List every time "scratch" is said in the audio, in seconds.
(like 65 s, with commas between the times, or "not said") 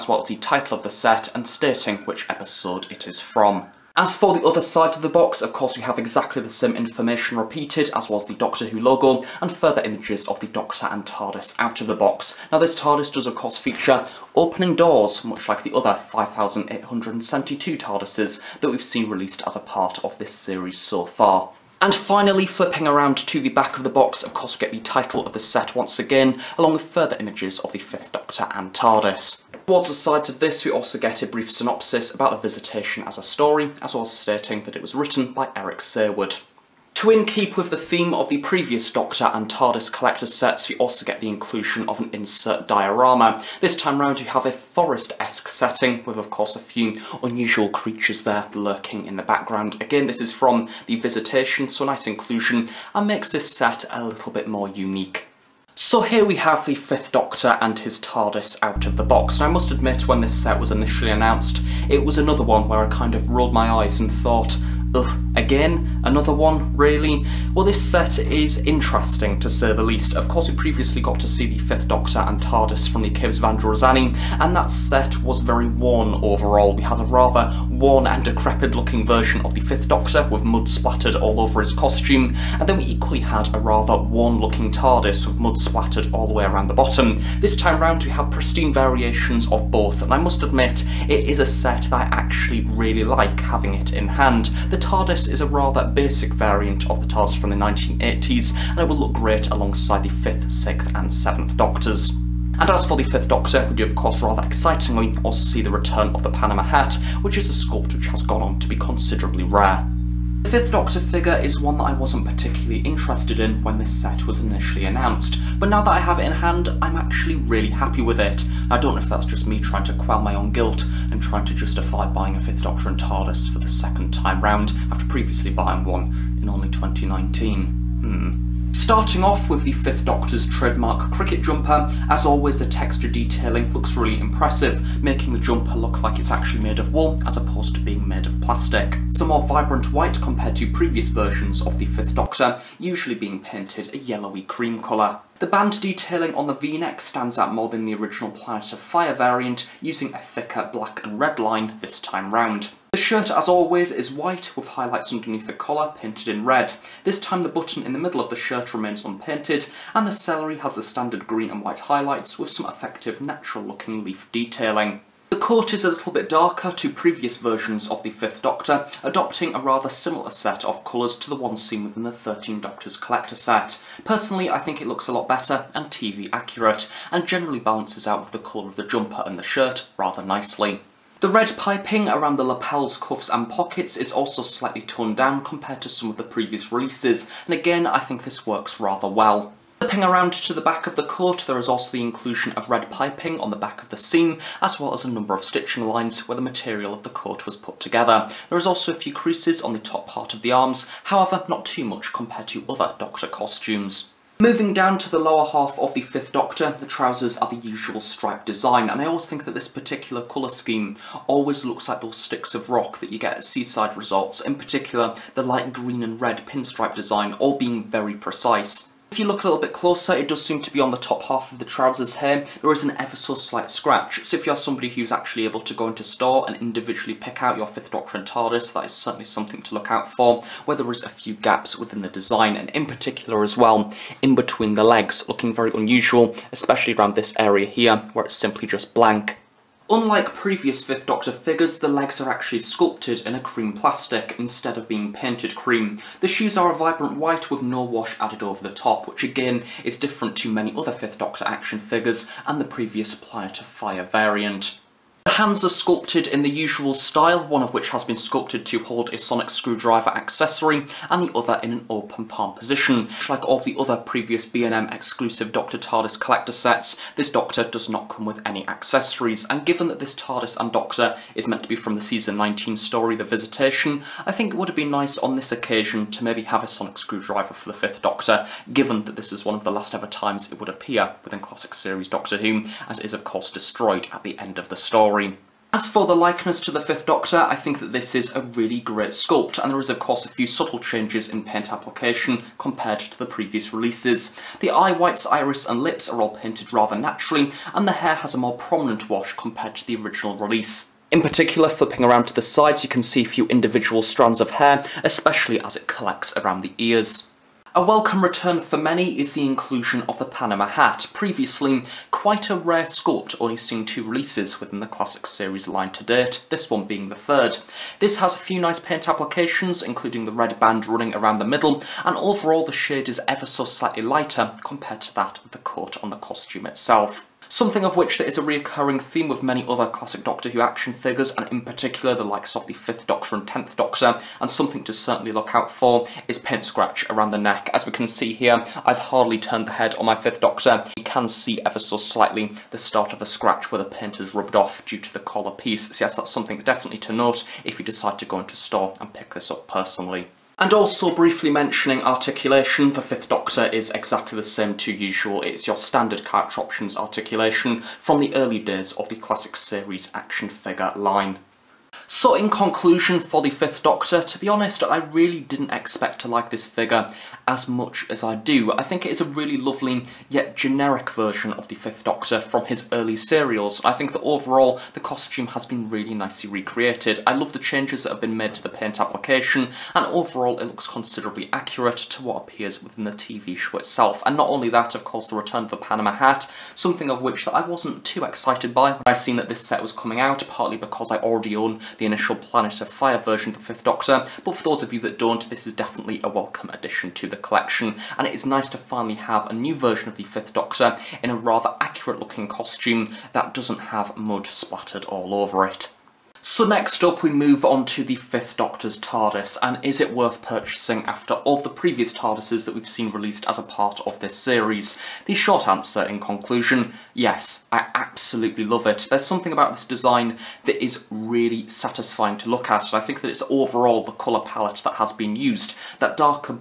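223 s, 336 s, 343 s.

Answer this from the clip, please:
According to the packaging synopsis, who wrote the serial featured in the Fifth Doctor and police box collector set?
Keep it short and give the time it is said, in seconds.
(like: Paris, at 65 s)
Eric Saward, at 35 s.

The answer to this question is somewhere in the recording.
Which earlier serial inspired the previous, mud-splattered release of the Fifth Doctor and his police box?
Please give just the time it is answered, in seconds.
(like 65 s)
73 s.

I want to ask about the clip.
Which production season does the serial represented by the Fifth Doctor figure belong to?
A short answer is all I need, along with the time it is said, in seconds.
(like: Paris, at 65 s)
Season 19, at 272 s.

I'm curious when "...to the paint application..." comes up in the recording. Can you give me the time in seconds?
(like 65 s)
378 s.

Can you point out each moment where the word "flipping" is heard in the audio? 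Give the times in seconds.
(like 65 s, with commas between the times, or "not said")
22 s, 189 s, 301 s.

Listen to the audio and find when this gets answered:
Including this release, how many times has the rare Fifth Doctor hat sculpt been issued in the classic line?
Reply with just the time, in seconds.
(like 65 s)
317 s.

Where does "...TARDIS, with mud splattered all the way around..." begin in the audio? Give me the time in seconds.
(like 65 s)
84 s.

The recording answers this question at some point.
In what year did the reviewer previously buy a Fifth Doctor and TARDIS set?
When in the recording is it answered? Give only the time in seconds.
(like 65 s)
126 s.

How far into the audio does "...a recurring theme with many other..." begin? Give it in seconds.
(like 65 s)
328 s.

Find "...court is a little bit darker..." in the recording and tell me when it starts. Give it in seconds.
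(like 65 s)
165 s.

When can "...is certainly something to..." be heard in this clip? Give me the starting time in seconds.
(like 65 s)
228 s.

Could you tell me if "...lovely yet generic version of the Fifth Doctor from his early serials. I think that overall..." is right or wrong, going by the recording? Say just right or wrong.
right.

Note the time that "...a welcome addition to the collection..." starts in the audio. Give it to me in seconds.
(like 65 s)
396 s.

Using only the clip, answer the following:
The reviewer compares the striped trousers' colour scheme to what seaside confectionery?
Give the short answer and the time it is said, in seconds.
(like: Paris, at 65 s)
Sticks of rock, at 212 s.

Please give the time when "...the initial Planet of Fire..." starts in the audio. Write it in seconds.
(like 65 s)
391 s.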